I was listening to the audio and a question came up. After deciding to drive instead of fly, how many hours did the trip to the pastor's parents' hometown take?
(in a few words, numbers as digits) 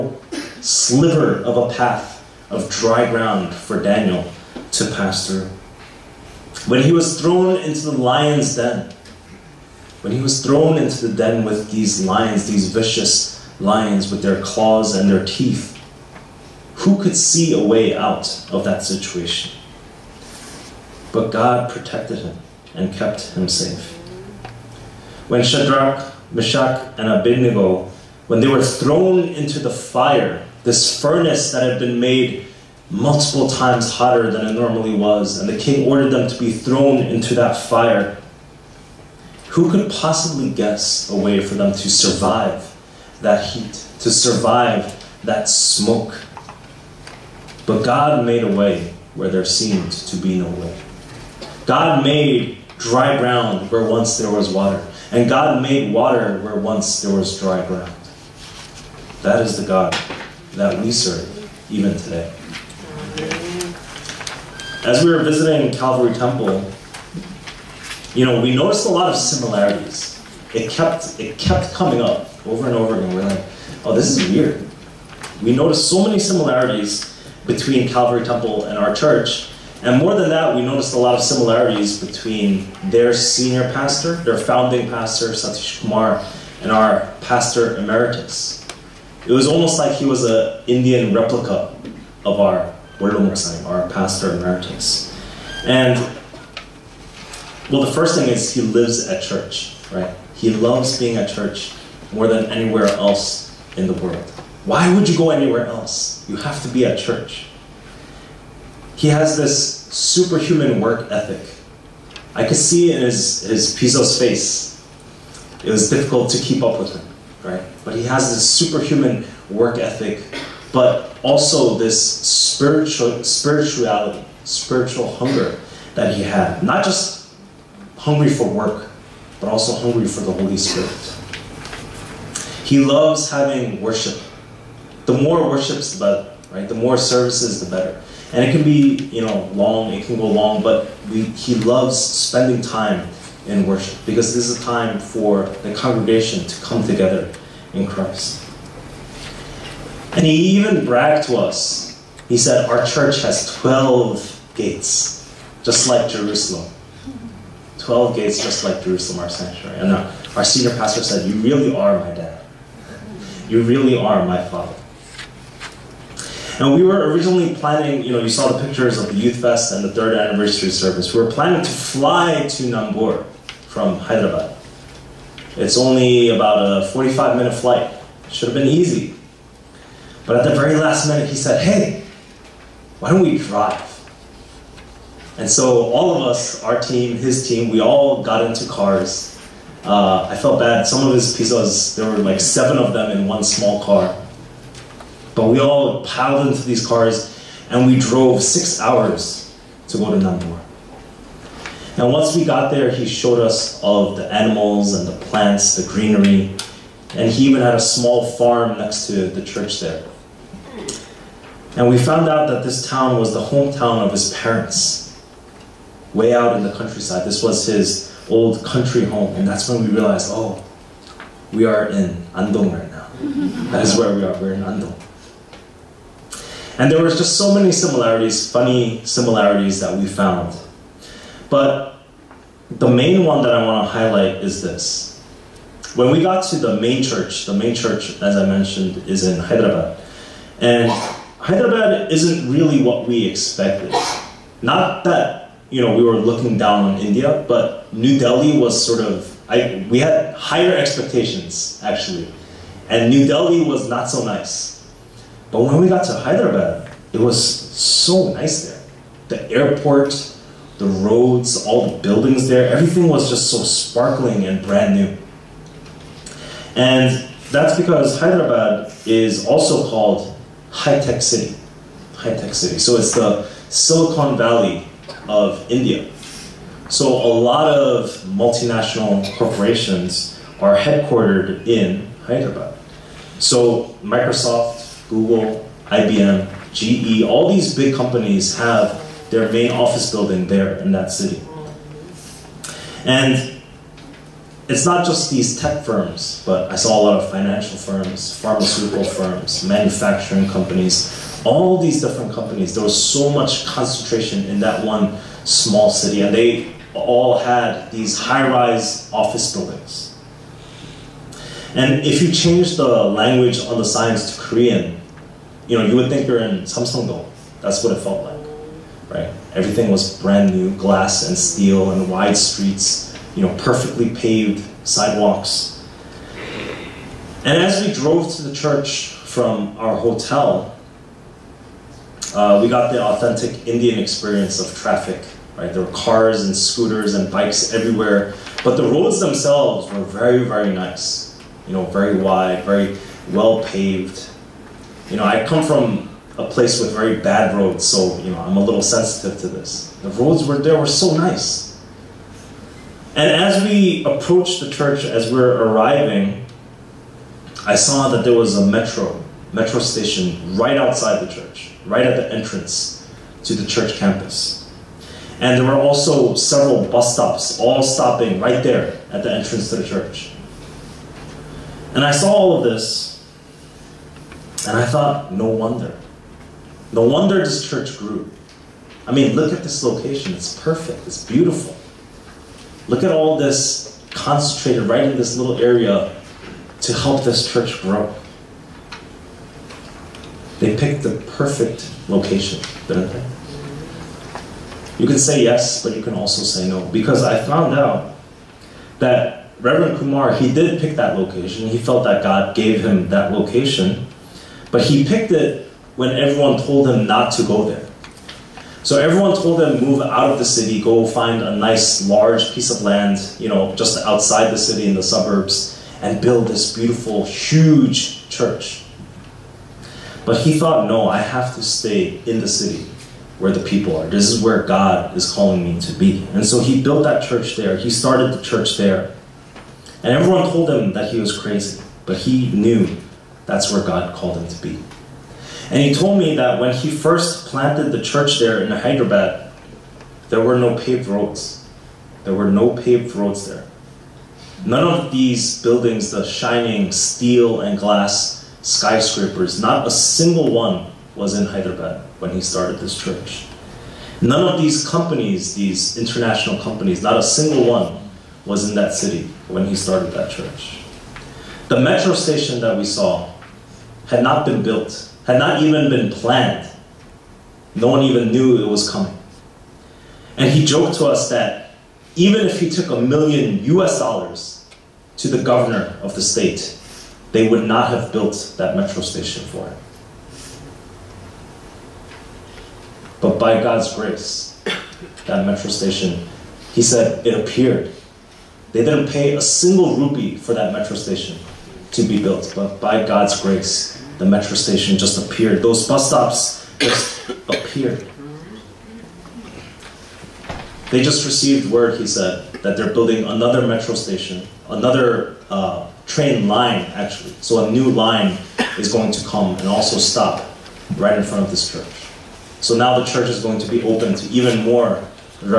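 6 hours.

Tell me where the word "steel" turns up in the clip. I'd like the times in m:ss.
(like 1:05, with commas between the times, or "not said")
5:21, 7:26.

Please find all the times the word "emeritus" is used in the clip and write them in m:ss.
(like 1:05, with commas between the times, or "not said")
1:27, 1:34.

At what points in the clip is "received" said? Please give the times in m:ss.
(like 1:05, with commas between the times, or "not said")
8:21.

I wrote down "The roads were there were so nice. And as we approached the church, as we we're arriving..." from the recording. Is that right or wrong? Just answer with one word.
right.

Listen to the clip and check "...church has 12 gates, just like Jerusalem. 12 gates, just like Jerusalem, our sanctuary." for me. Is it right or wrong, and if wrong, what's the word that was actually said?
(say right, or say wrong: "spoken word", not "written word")
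right.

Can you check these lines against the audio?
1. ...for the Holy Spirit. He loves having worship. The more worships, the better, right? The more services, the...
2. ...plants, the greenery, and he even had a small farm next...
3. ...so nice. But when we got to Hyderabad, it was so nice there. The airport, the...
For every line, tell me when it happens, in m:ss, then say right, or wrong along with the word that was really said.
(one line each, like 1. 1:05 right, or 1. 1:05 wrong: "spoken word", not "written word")
1. 2:10 right
2. 3:25 right
3. 4:14 right.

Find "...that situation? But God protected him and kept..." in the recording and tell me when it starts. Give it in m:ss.
0:18.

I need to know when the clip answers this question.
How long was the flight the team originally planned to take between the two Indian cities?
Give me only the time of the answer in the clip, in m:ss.
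2:56.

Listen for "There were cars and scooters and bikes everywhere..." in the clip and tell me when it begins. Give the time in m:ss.
5:35.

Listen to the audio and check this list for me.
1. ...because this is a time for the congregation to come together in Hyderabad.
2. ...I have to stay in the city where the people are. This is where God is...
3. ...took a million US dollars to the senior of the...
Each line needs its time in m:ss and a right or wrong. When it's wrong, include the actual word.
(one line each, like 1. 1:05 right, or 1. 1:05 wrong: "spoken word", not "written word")
1. 2:24 wrong: "Christ", not "Hyderabad"
2. 7:01 right
3. 7:52 wrong: "governor", not "senior".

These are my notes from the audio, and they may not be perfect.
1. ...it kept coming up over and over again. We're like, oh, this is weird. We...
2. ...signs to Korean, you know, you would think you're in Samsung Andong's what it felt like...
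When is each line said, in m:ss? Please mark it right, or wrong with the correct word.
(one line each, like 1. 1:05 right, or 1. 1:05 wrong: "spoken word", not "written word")
1. 1:11 right
2. 5:13 wrong: "That", not "Andong".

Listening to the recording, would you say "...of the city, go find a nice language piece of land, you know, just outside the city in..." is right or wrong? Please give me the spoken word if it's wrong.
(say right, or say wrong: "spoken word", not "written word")
wrong: "large", not "language".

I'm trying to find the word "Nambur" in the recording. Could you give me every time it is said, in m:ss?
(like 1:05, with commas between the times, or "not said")
2:52, 3:20.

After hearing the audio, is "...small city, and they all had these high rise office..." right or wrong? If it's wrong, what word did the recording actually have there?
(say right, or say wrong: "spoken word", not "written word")
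right.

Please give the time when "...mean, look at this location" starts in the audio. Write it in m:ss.
6:19.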